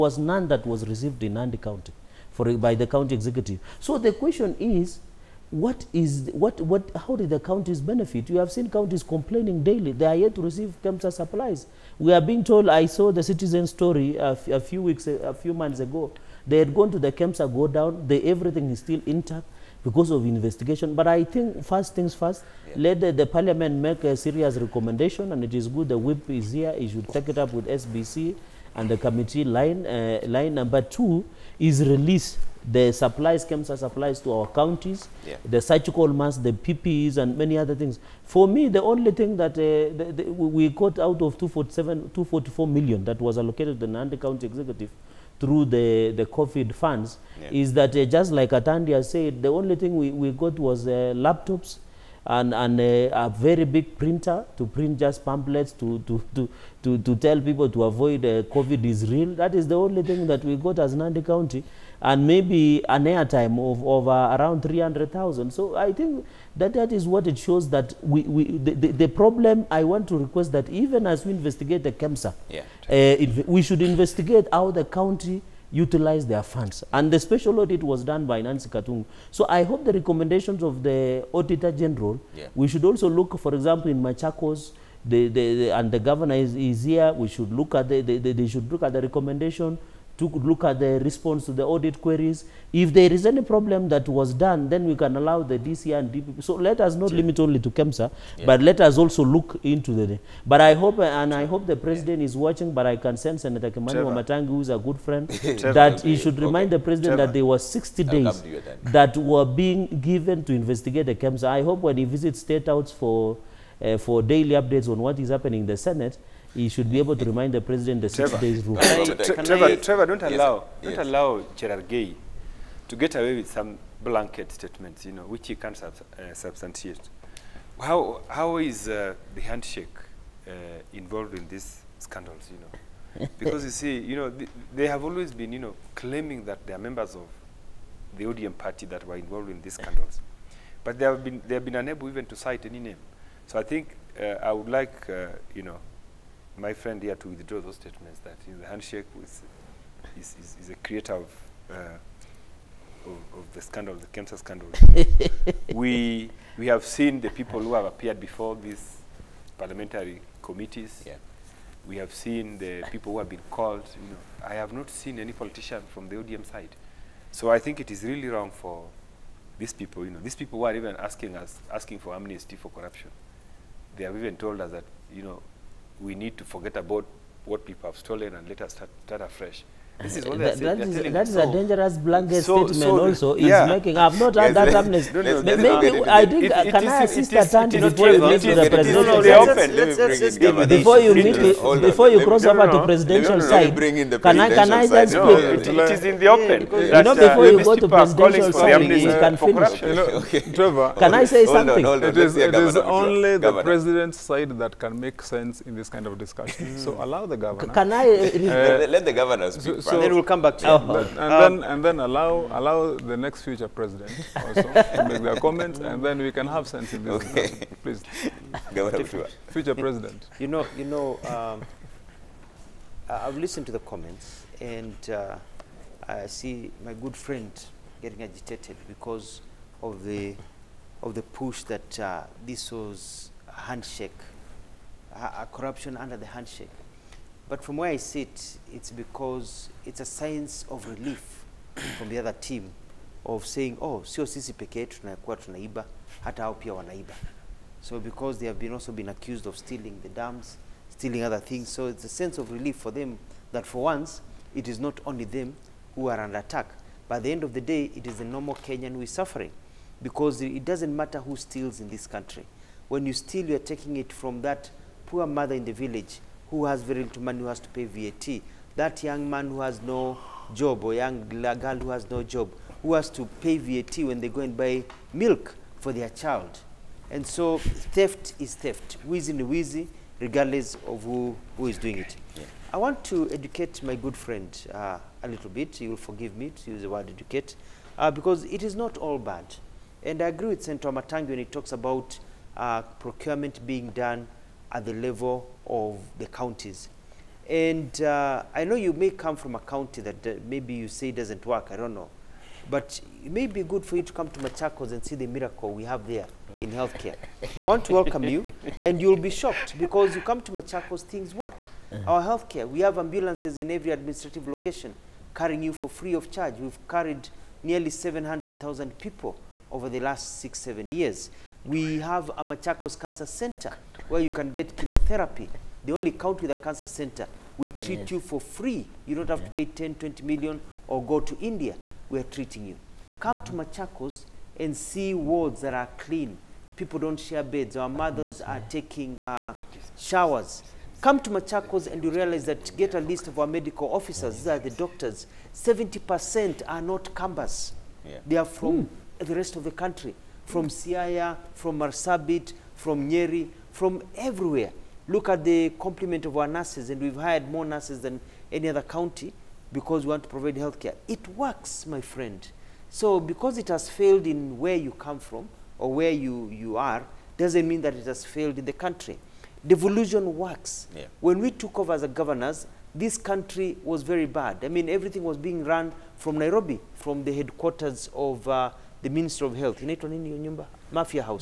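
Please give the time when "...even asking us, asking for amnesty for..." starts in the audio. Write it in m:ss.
2:50.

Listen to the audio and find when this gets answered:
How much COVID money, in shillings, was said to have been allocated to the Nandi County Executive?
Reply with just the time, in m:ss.
0:42.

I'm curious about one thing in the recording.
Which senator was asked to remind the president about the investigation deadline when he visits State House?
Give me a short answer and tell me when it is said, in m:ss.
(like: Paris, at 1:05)
Kimani Wamatangi, at 1:43.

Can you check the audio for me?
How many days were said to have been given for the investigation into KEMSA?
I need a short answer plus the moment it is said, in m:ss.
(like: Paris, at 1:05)
60, at 1:47.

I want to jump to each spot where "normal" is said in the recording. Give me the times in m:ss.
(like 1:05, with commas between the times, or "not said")
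4:18.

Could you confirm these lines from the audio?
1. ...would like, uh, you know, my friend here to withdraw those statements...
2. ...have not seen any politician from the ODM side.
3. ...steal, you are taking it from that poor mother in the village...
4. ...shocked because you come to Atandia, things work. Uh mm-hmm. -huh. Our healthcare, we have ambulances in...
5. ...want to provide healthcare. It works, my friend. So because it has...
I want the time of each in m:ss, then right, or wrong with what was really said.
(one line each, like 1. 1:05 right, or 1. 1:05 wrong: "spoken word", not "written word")
1. 2:24 right
2. 2:44 right
3. 4:23 right
4. 5:09 wrong: "Machakos", not "Atandia"
5. 6:00 right.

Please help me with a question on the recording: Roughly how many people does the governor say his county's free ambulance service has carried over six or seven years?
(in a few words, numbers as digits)
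700,000.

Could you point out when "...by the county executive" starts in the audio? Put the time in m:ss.
0:02.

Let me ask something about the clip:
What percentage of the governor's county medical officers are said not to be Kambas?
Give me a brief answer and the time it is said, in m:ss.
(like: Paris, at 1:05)
70%, at 5:45.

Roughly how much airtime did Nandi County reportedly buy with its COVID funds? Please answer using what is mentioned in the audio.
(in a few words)
300,000.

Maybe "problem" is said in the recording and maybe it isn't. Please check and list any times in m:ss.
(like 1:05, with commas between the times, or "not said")
1:09, 1:33.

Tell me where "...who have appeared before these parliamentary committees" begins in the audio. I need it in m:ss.
2:37.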